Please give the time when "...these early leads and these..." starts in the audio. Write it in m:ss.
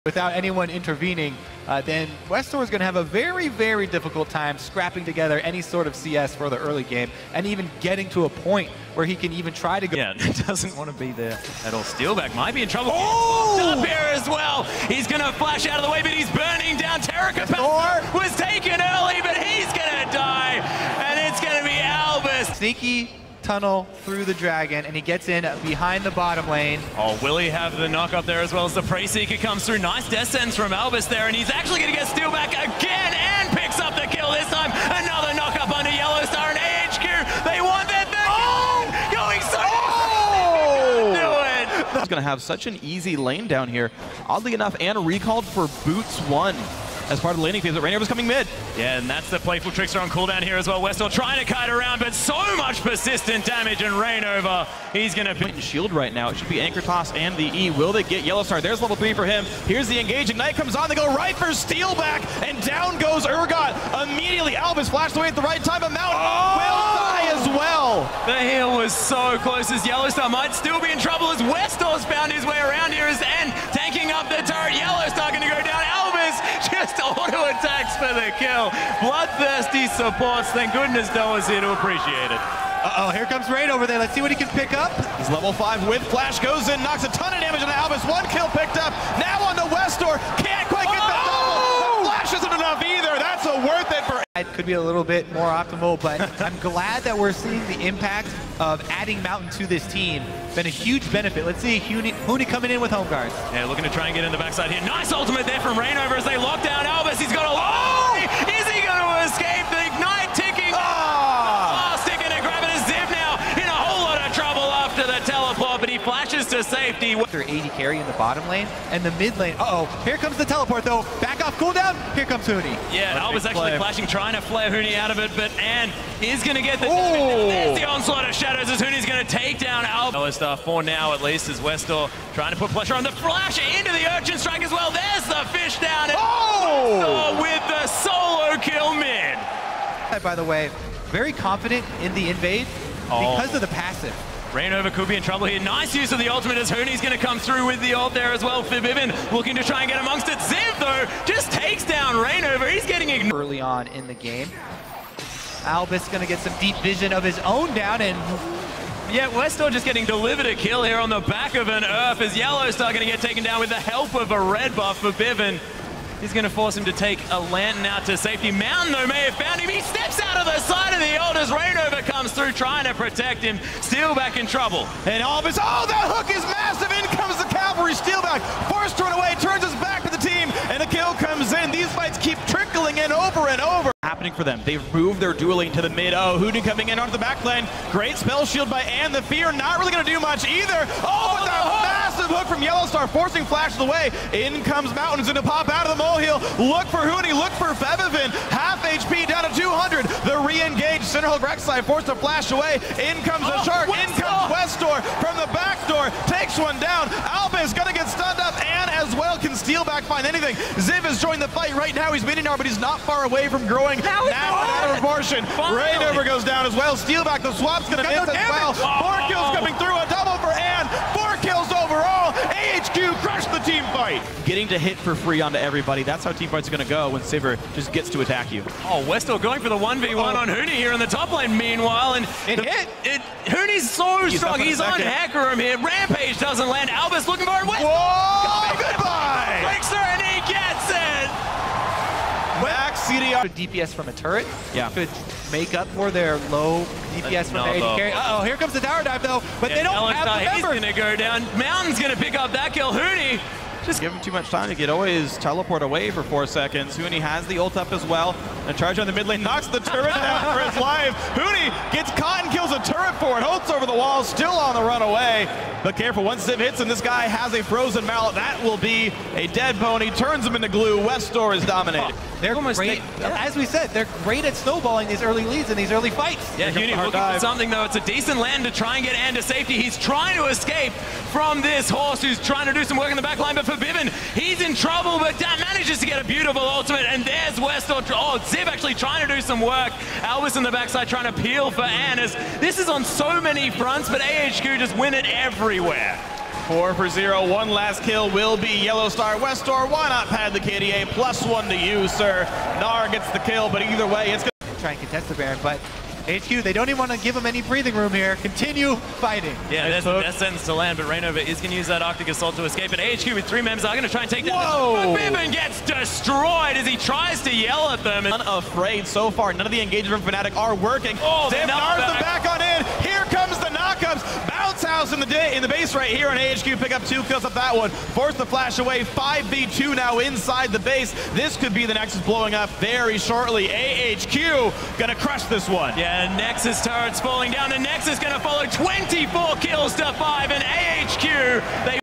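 4:35.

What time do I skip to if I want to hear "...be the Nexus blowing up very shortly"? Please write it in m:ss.
5:31.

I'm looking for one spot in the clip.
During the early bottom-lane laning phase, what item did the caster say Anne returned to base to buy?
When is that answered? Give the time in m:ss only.
0:45.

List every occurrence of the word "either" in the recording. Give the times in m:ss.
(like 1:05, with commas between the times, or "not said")
1:32, 3:10, 5:03.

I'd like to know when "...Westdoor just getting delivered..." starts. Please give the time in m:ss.
2:39.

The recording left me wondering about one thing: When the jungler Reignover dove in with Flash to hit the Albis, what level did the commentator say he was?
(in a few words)
5.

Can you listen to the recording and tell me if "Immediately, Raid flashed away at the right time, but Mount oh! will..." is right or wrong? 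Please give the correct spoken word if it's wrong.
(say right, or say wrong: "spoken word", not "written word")
wrong: "Albis", not "Raid".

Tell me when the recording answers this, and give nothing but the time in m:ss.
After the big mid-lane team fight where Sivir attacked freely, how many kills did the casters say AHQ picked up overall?
3:41.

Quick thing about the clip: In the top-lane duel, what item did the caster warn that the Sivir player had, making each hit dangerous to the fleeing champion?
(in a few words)
Frozen Mallet.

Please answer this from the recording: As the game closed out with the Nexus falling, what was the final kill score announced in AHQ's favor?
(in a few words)
24 to 5.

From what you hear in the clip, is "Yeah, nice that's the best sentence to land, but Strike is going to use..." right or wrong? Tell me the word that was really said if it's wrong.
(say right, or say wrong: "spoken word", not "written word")
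wrong: "Reignover", not "Strike".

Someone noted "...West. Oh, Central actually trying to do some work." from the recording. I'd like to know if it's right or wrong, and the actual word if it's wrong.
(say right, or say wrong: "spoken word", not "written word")
wrong: "Ziv", not "Central".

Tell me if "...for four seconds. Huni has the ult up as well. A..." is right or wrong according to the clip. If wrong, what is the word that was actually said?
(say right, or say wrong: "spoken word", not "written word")
right.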